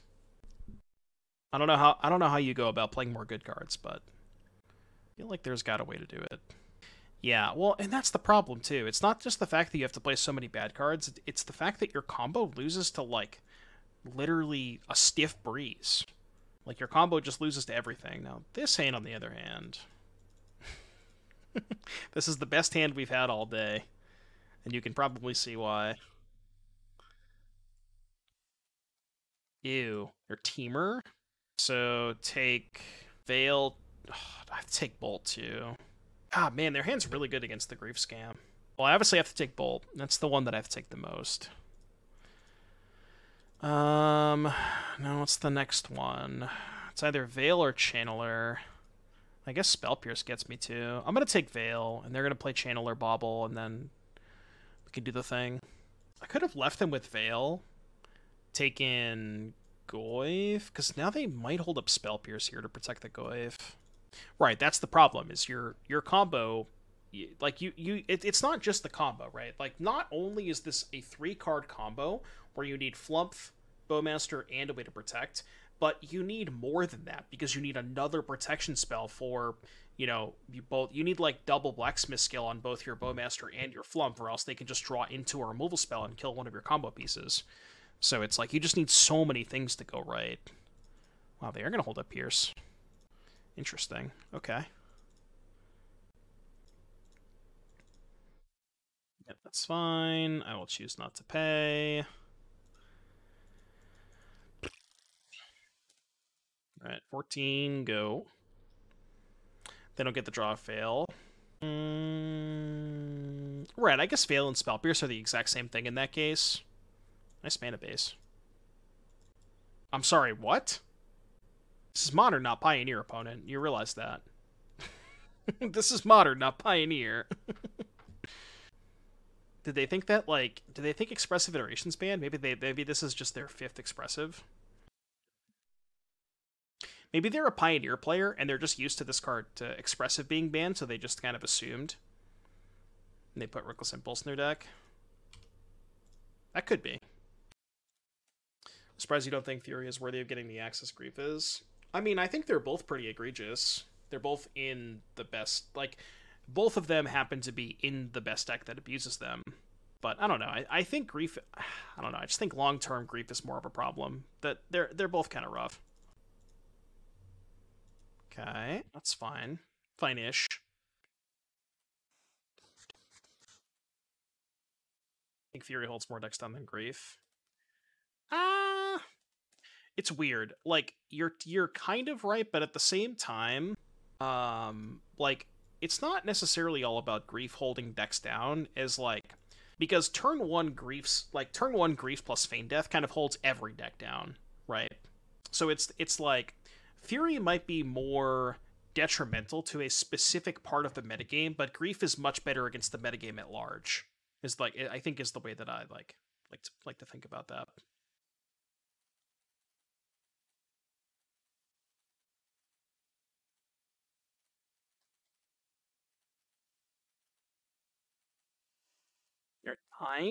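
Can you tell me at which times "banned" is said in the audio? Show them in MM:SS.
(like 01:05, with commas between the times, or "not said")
02:11, 02:20.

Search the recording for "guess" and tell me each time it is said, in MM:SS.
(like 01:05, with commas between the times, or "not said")
00:49, 01:54.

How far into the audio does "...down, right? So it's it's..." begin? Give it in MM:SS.
03:13.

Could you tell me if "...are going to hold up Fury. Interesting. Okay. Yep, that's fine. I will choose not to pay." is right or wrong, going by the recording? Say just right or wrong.
wrong.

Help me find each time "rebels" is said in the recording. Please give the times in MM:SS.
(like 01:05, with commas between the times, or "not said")
not said.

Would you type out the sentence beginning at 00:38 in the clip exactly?
Well, I obviously have to take Bolt.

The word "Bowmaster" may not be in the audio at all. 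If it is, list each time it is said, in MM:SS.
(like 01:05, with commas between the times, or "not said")
01:13, 01:22.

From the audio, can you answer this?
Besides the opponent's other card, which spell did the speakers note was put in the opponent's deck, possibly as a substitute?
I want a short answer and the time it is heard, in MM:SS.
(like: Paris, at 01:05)
Reckless Impulse, at 02:23.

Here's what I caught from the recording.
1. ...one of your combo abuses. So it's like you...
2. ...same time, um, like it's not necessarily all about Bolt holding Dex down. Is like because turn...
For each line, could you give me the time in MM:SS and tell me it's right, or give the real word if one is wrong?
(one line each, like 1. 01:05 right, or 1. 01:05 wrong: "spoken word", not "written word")
1. 01:26 wrong: "pieces", not "abuses"
2. 03:02 wrong: "Grief", not "Bolt".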